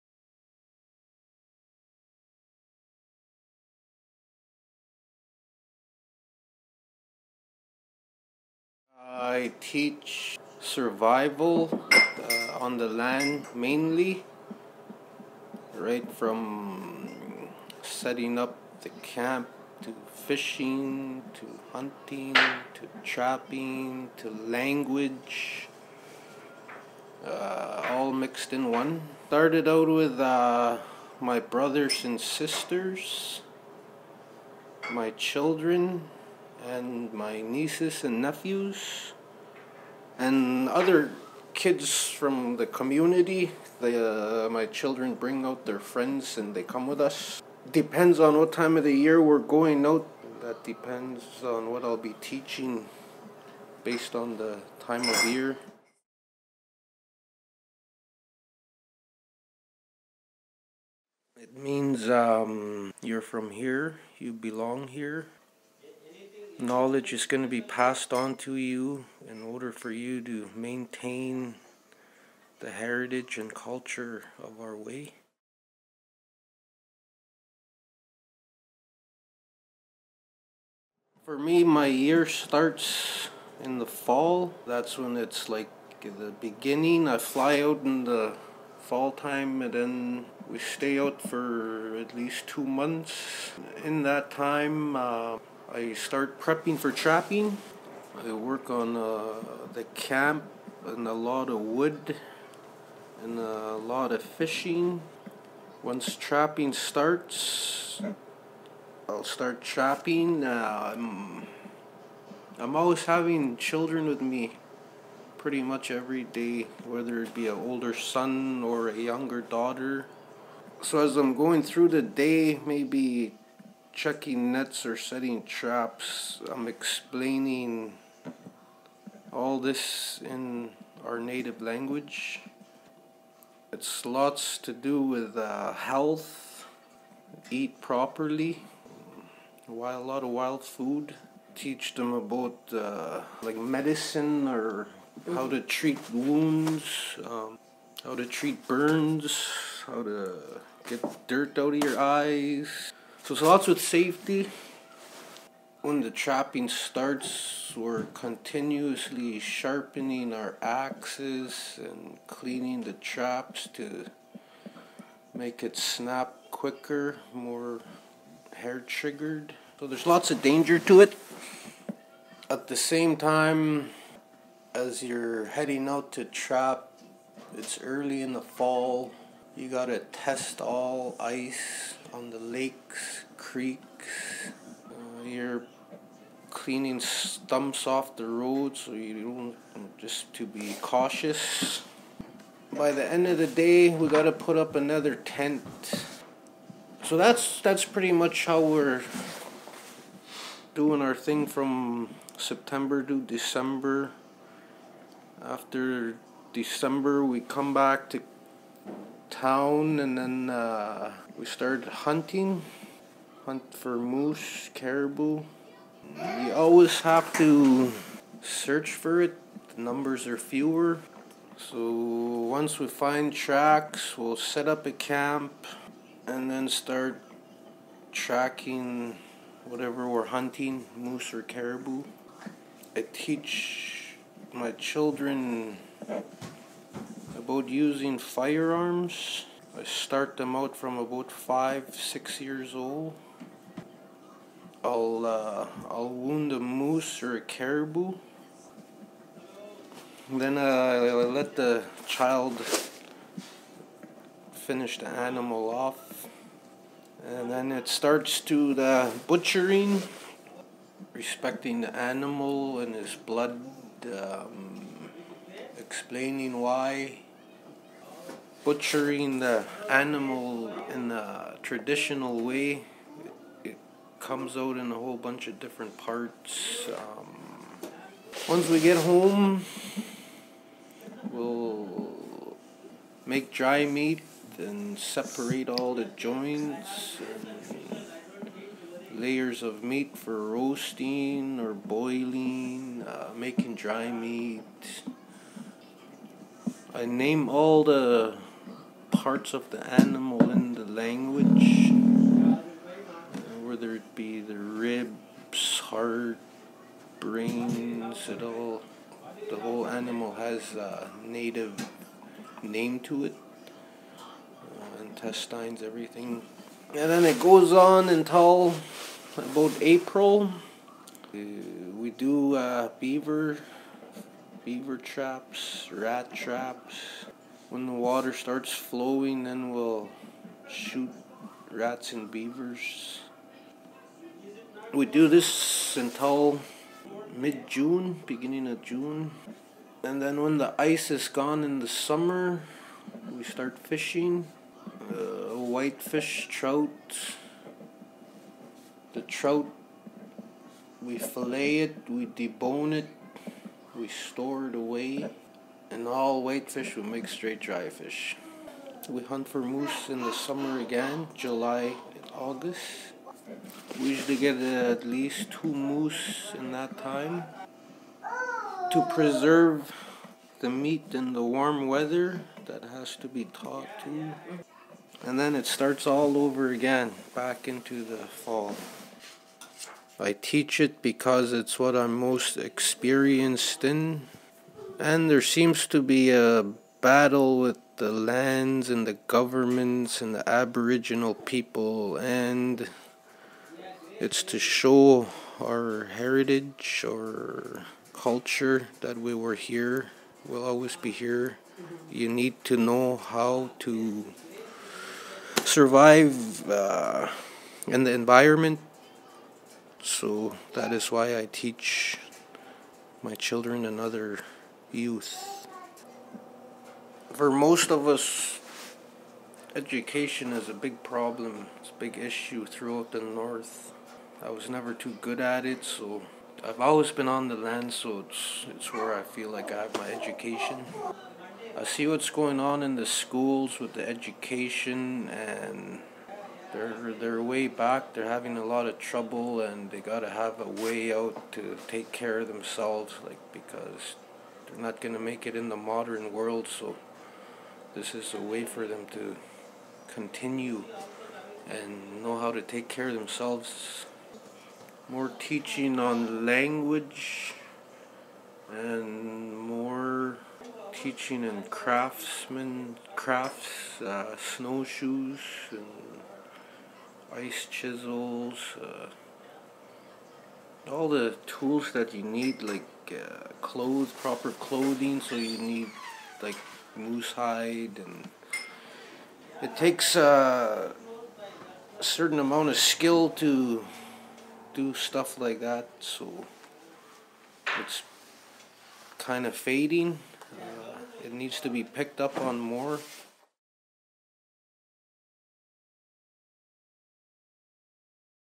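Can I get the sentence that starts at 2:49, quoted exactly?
So there's lots of danger to it.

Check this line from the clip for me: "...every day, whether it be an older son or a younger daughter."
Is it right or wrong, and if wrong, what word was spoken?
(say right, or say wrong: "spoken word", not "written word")
right.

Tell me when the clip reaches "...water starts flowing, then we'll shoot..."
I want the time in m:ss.
5:27.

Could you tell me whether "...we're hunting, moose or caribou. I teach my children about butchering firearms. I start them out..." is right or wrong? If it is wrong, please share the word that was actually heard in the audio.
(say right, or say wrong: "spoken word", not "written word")
wrong: "using", not "butchering".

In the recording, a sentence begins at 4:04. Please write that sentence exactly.
I'll uh, I'll wound a moose or a caribou.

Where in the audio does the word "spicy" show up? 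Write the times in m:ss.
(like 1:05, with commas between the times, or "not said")
not said.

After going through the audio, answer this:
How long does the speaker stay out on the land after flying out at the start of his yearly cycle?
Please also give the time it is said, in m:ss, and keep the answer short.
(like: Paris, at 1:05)
At least two months, at 1:31.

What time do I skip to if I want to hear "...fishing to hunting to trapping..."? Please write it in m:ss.
0:20.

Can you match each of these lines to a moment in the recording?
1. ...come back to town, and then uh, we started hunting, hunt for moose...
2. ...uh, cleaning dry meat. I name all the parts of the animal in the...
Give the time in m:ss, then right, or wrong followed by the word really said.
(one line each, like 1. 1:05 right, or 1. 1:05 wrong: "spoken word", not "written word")
1. 3:27 right
2. 4:53 wrong: "making", not "cleaning".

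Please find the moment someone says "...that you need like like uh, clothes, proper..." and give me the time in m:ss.
7:51.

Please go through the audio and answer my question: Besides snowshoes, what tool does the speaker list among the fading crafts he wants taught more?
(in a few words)
Ice chisels.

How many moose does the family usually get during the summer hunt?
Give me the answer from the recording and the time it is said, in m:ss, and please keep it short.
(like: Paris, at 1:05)
2, at 6:04.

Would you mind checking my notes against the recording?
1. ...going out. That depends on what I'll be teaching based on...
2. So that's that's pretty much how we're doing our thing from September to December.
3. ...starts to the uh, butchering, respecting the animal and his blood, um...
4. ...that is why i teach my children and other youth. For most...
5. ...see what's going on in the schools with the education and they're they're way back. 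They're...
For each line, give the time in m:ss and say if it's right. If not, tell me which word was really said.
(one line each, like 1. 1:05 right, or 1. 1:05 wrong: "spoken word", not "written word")
1. 0:49 right
2. 3:17 right
3. 4:17 right
4. 6:50 right
5. 7:11 right.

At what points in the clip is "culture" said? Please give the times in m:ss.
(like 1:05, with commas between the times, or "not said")
1:13, 6:38.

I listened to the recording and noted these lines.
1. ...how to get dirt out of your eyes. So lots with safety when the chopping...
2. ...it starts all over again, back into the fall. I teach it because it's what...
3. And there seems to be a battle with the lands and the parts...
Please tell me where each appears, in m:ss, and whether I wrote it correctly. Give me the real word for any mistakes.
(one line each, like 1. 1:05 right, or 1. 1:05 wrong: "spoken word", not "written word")
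1. 2:29 right
2. 6:15 right
3. 6:25 wrong: "governments", not "parts".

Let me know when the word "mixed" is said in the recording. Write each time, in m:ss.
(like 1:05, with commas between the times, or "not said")
0:28.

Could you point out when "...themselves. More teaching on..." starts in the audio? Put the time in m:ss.
7:33.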